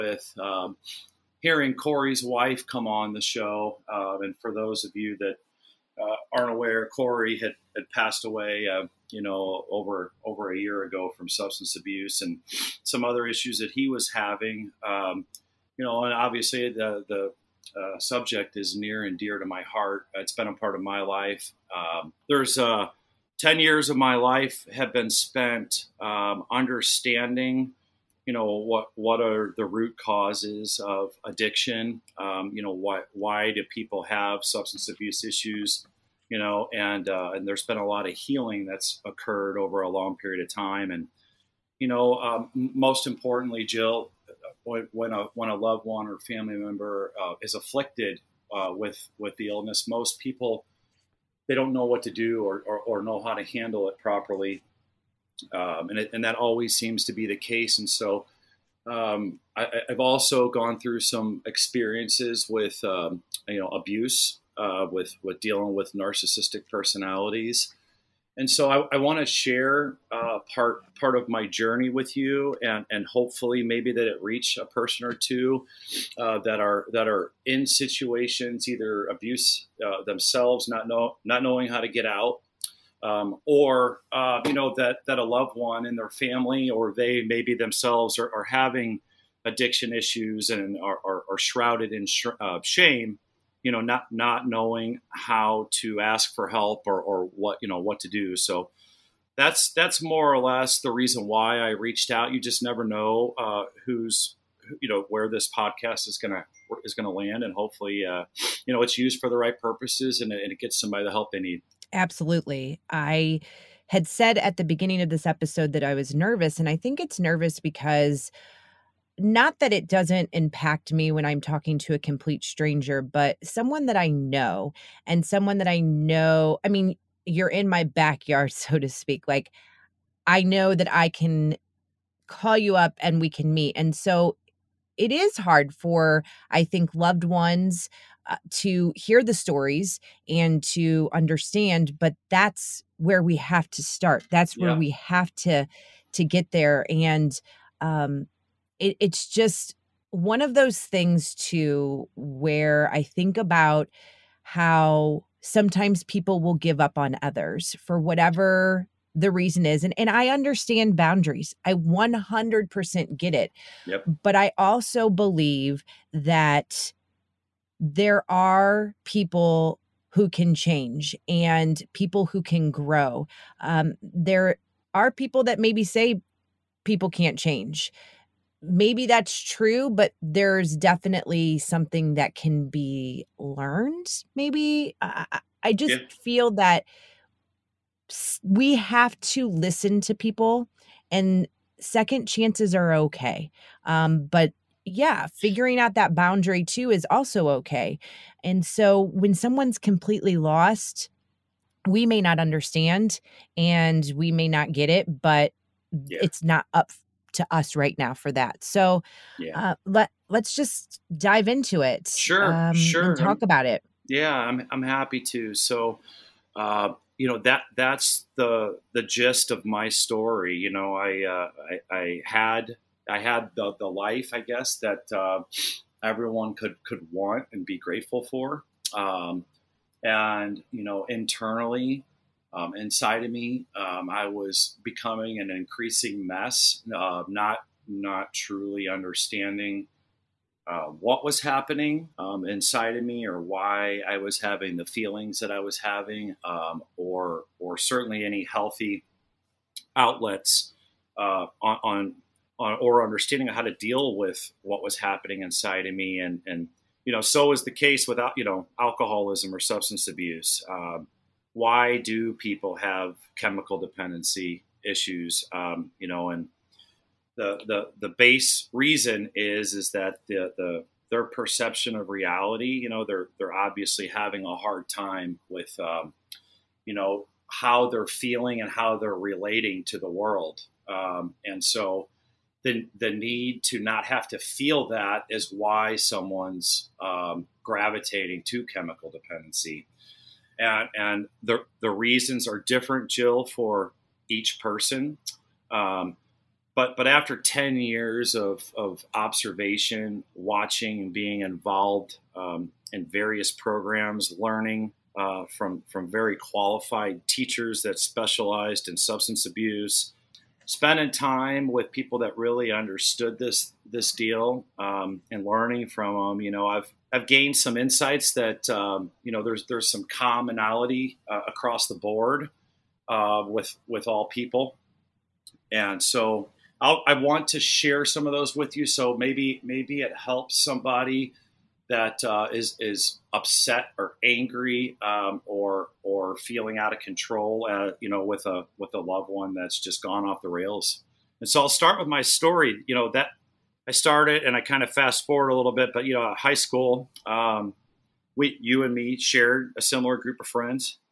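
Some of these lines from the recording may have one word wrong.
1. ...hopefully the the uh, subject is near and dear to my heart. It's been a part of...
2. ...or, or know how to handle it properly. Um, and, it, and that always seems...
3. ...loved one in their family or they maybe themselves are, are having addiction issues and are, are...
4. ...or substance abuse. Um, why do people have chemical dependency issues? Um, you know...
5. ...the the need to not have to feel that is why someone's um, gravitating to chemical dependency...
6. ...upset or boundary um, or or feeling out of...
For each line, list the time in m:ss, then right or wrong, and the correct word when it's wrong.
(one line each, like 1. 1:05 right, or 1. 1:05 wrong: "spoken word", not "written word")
1. 0:16 wrong: "obviously", not "hopefully"
2. 0:52 right
3. 1:25 right
4. 4:19 right
5. 4:42 right
6. 5:33 wrong: "angry", not "boundary".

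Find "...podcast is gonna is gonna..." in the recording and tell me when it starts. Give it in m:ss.
1:45.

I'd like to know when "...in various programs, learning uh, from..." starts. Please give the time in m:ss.
5:02.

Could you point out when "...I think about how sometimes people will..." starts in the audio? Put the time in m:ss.
2:32.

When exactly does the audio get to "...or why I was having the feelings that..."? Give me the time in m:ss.
4:03.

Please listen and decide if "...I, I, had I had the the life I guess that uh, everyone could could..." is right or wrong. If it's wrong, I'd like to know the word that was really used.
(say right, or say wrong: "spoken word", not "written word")
right.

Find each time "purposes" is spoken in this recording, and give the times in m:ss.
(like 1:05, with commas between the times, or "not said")
1:49.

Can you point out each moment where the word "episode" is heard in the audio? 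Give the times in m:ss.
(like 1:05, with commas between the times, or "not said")
1:55.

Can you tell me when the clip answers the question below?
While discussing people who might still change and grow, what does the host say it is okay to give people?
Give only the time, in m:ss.
3:11.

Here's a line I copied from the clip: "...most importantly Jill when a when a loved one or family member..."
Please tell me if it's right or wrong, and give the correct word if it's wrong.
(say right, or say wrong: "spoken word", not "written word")
right.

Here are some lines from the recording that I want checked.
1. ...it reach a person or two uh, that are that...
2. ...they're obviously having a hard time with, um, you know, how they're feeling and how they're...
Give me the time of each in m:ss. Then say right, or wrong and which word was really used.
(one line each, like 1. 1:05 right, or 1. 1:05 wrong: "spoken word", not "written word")
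1. 1:14 right
2. 4:33 right.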